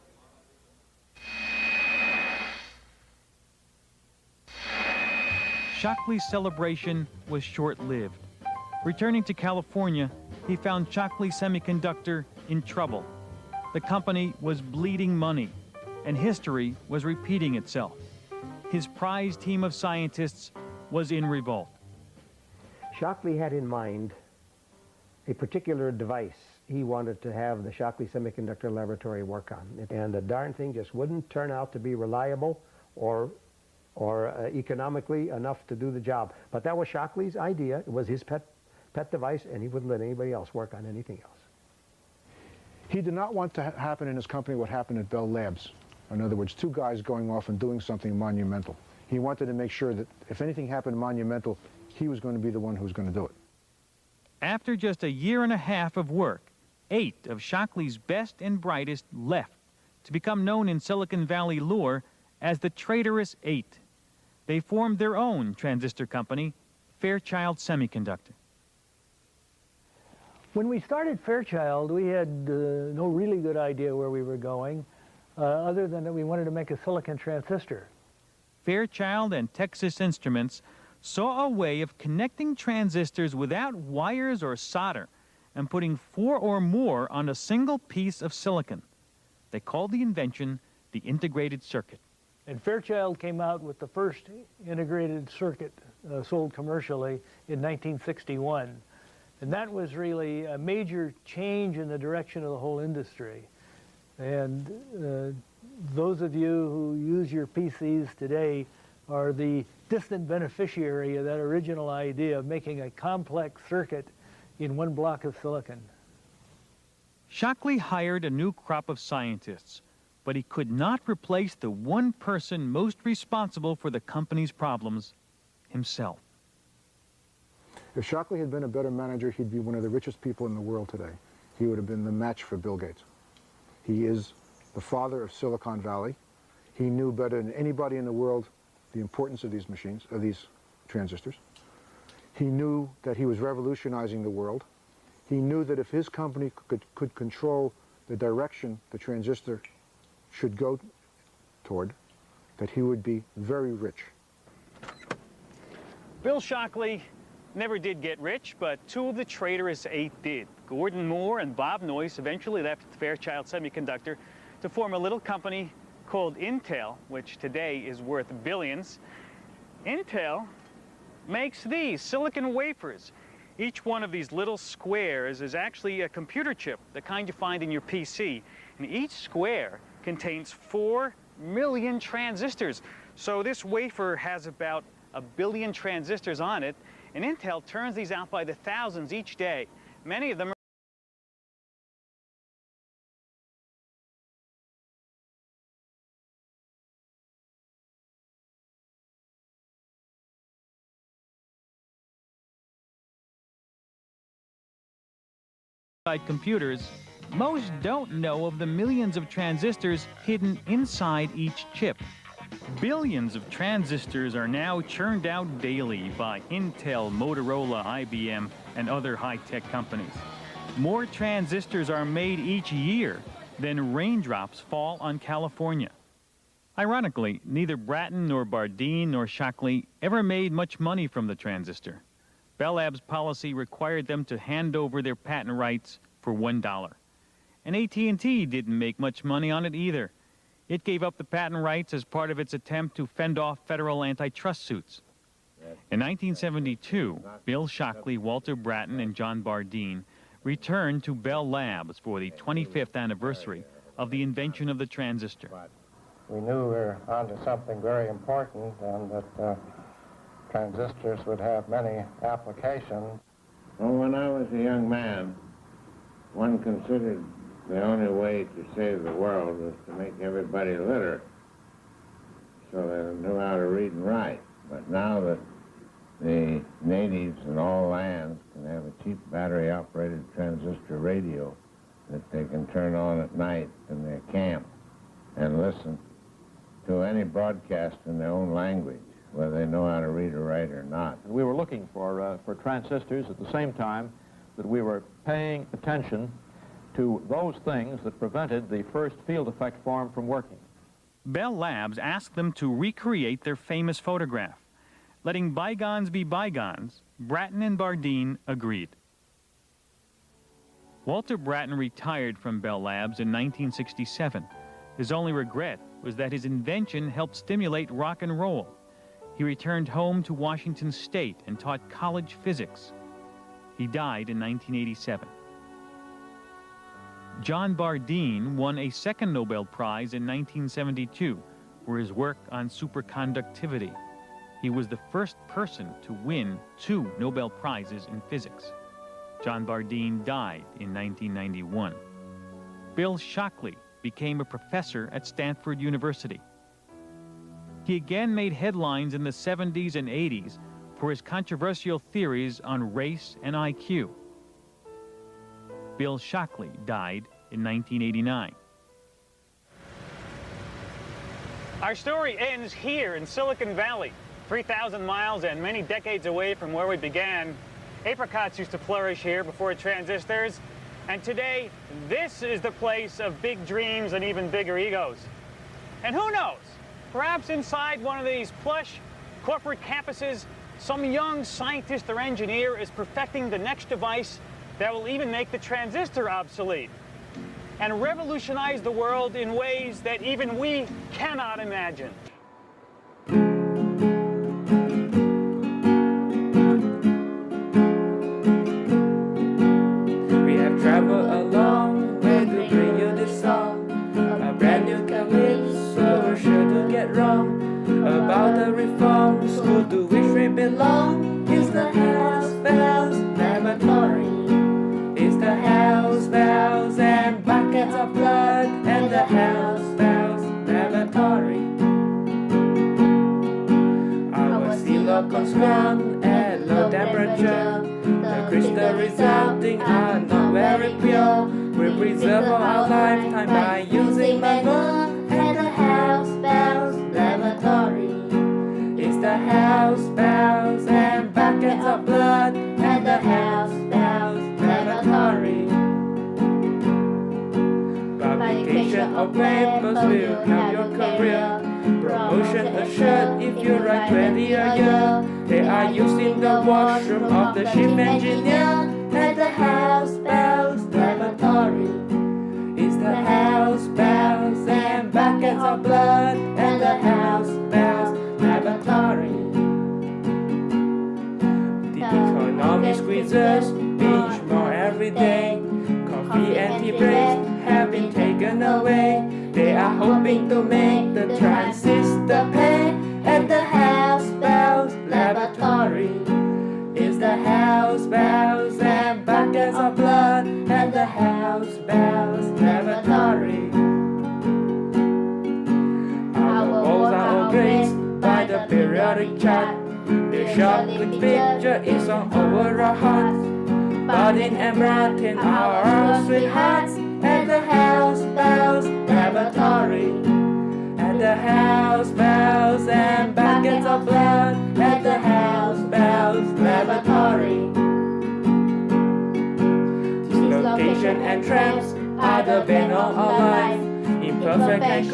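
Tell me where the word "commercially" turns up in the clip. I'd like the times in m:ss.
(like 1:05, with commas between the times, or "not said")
1:36.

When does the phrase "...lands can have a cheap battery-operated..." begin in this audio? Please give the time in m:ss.
4:37.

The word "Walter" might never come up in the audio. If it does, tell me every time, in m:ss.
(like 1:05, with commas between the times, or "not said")
4:08, 5:11.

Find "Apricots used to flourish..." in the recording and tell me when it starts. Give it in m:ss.
6:08.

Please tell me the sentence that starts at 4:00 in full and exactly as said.
It gave up the patent rights as part of its attempt to fend off federal antitrust suits.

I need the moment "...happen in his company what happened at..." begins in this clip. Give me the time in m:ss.
0:43.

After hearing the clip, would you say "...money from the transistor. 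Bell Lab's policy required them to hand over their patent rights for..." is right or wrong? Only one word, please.
right.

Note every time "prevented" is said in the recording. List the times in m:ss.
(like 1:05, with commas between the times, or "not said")
4:58.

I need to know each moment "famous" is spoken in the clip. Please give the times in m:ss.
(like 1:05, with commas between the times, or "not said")
5:03.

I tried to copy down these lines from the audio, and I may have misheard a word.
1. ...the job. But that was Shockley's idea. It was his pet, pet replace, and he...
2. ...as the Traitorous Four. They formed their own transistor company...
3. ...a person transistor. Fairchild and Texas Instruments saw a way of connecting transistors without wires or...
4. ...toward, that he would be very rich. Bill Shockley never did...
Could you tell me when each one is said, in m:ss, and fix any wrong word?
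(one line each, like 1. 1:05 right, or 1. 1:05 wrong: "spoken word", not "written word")
1. 0:35 wrong: "device", not "replace"
2. 1:02 wrong: "Eight", not "Four"
3. 1:16 wrong: "silicon", not "person"
4. 2:31 right.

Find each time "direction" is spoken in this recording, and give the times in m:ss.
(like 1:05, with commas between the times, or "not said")
1:41, 2:28.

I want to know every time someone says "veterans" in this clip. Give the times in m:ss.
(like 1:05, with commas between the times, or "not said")
not said.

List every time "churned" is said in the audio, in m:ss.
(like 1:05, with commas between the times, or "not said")
3:34.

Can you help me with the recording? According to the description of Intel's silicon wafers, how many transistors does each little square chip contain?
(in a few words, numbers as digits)
4 million.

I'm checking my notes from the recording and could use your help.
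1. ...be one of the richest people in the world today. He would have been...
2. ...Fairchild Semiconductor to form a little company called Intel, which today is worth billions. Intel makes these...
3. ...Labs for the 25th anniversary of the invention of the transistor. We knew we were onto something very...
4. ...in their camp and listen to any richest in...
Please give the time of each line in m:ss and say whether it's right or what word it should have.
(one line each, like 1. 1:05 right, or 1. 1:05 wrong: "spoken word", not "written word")
1. 2:09 right
2. 2:42 right
3. 4:11 right
4. 4:43 wrong: "broadcast", not "richest".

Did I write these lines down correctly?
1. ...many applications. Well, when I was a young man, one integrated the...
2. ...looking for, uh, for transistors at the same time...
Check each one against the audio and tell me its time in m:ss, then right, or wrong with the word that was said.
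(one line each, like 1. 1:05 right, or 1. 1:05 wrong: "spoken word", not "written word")
1. 4:21 wrong: "considered", not "integrated"
2. 4:51 right.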